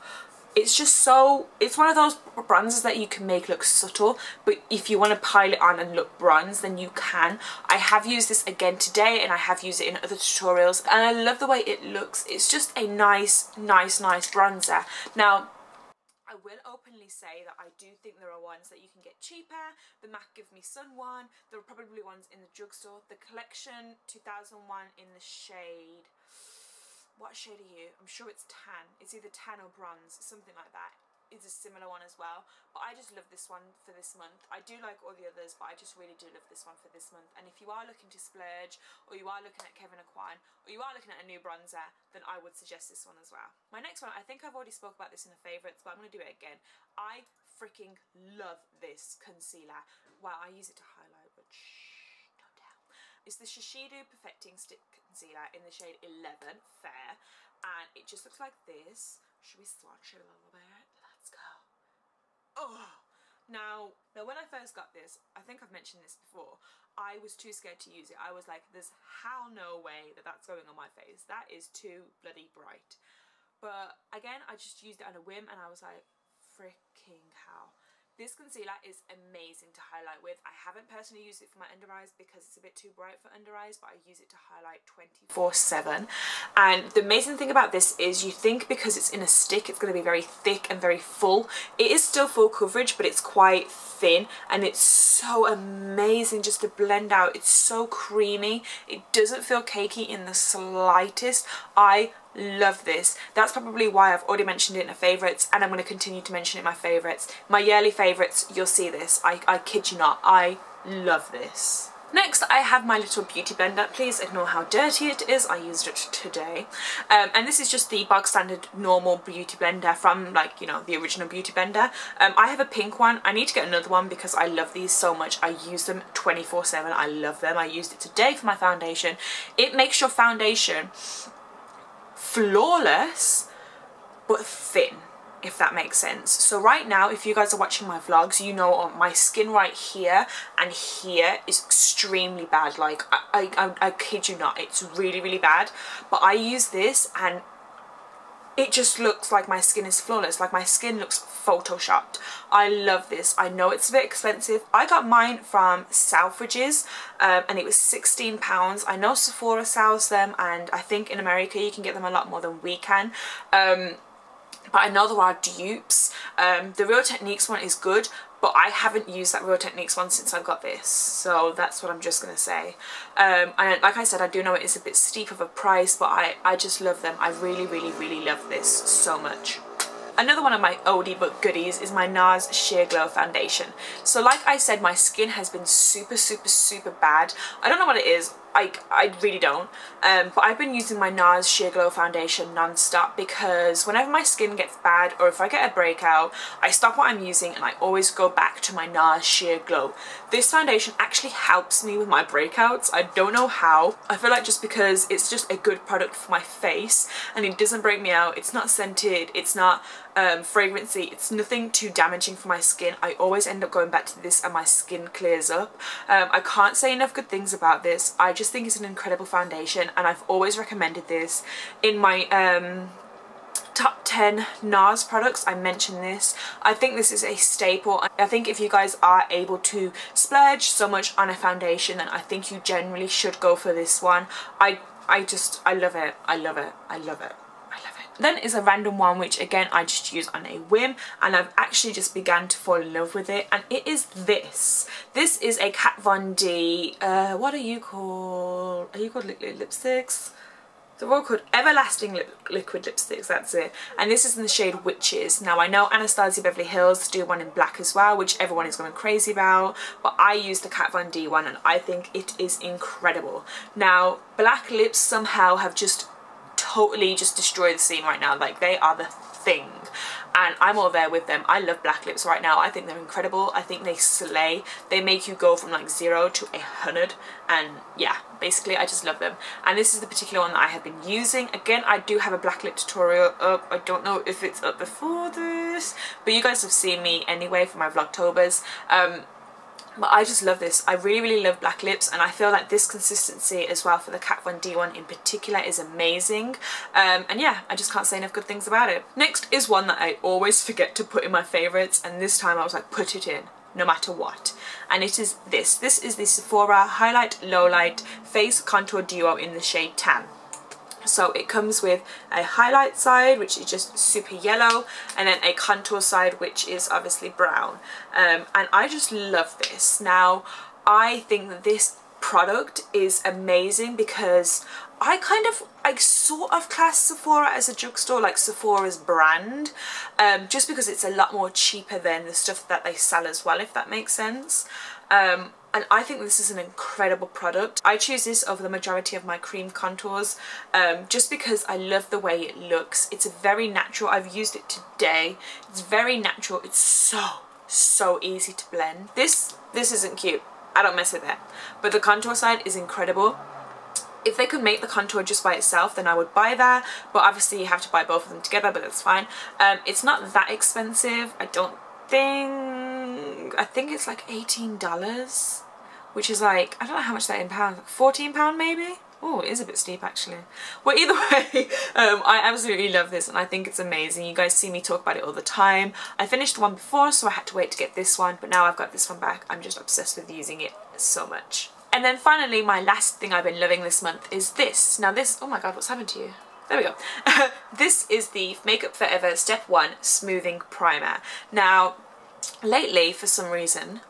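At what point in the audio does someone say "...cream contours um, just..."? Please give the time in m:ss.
5:39.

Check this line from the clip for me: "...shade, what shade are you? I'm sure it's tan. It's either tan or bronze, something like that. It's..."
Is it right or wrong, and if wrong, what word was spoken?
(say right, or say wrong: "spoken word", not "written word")
right.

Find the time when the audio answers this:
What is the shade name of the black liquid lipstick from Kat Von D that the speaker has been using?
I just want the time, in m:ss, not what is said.
4:14.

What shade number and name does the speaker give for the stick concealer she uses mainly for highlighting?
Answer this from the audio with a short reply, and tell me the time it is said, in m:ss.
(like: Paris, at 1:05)
11, Fair, at 0:56.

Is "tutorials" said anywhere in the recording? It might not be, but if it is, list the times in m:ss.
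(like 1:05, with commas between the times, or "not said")
0:10, 4:42.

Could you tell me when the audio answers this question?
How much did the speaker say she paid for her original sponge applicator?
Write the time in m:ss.
2:37.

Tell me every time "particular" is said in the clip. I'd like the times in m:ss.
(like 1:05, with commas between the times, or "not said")
4:40, 4:55.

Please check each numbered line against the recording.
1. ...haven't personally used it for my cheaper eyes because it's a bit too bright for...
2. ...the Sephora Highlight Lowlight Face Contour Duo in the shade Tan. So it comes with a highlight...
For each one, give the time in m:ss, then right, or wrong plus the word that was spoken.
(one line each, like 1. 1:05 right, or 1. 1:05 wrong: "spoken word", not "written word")
1. 1:20 wrong: "under", not "cheaper"
2. 5:06 right.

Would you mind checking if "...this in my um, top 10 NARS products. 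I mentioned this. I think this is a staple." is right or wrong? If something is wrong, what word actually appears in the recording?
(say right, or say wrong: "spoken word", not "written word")
right.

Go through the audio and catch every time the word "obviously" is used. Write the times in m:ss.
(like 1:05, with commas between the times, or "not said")
5:16, 5:57.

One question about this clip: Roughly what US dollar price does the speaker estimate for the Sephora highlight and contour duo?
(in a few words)
$18.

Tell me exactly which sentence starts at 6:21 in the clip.
And then finally, my last thing I've been loving this month is this.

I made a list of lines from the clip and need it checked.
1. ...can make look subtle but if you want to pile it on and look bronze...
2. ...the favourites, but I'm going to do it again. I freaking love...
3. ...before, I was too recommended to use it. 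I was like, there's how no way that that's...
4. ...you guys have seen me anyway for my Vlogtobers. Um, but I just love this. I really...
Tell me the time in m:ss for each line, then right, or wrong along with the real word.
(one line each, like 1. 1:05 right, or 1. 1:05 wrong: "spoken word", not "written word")
1. 0:03 right
2. 0:45 right
3. 1:06 wrong: "scared", not "recommended"
4. 4:46 right.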